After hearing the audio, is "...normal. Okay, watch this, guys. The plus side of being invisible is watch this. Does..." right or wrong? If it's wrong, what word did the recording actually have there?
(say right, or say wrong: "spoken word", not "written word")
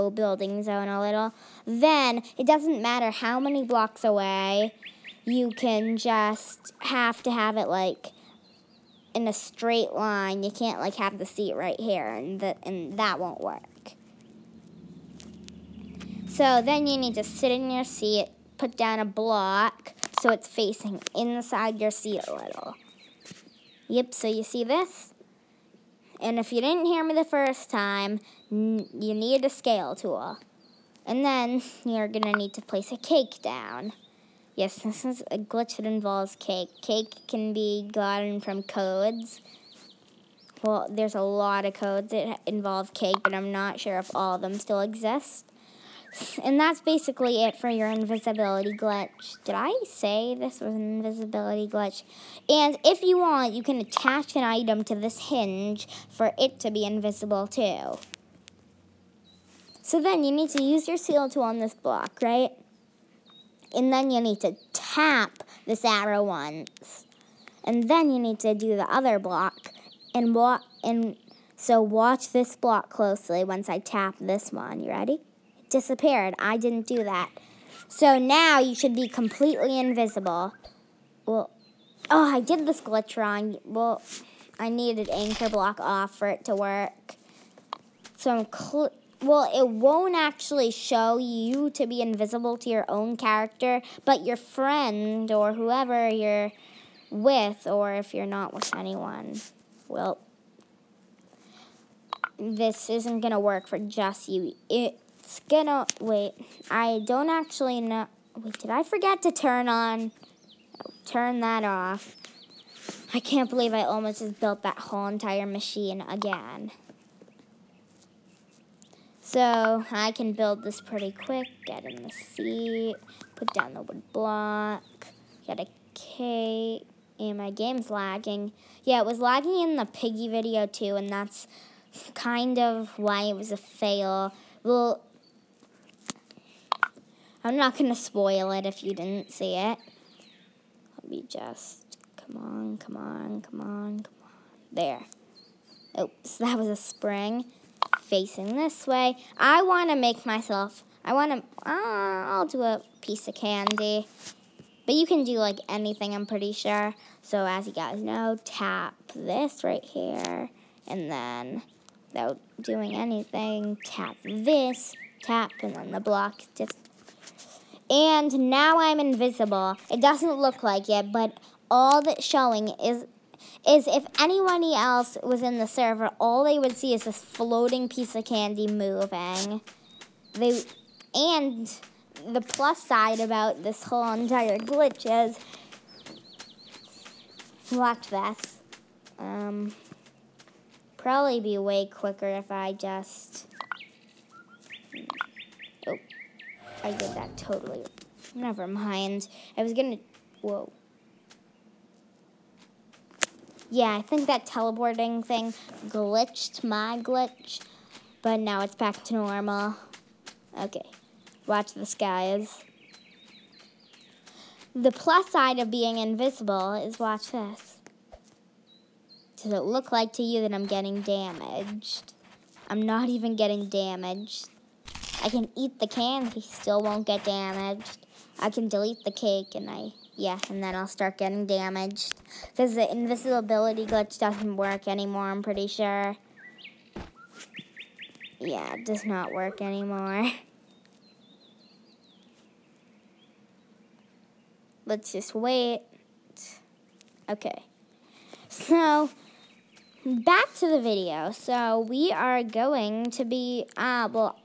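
right.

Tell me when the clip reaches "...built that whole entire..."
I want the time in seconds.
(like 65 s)
114 s.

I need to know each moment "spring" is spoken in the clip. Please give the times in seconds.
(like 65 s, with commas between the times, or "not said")
146 s.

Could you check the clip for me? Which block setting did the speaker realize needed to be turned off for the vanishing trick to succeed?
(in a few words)
Anchor.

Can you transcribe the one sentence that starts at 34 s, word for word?
Yes, this is a glitch that involves cake.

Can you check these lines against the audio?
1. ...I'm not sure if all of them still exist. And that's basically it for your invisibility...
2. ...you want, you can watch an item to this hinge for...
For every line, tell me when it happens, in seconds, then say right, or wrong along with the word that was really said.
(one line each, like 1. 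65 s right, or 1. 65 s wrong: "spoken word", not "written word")
1. 43 s right
2. 53 s wrong: "attach", not "watch".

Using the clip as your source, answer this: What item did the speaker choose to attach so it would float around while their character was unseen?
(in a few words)
A piece of candy.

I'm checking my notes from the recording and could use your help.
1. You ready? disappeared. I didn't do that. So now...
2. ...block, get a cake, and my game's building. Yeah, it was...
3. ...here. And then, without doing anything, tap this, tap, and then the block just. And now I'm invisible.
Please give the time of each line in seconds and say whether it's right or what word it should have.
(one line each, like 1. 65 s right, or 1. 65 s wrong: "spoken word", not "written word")
1. 74 s right
2. 124 s wrong: "lagging", not "building"
3. 159 s right.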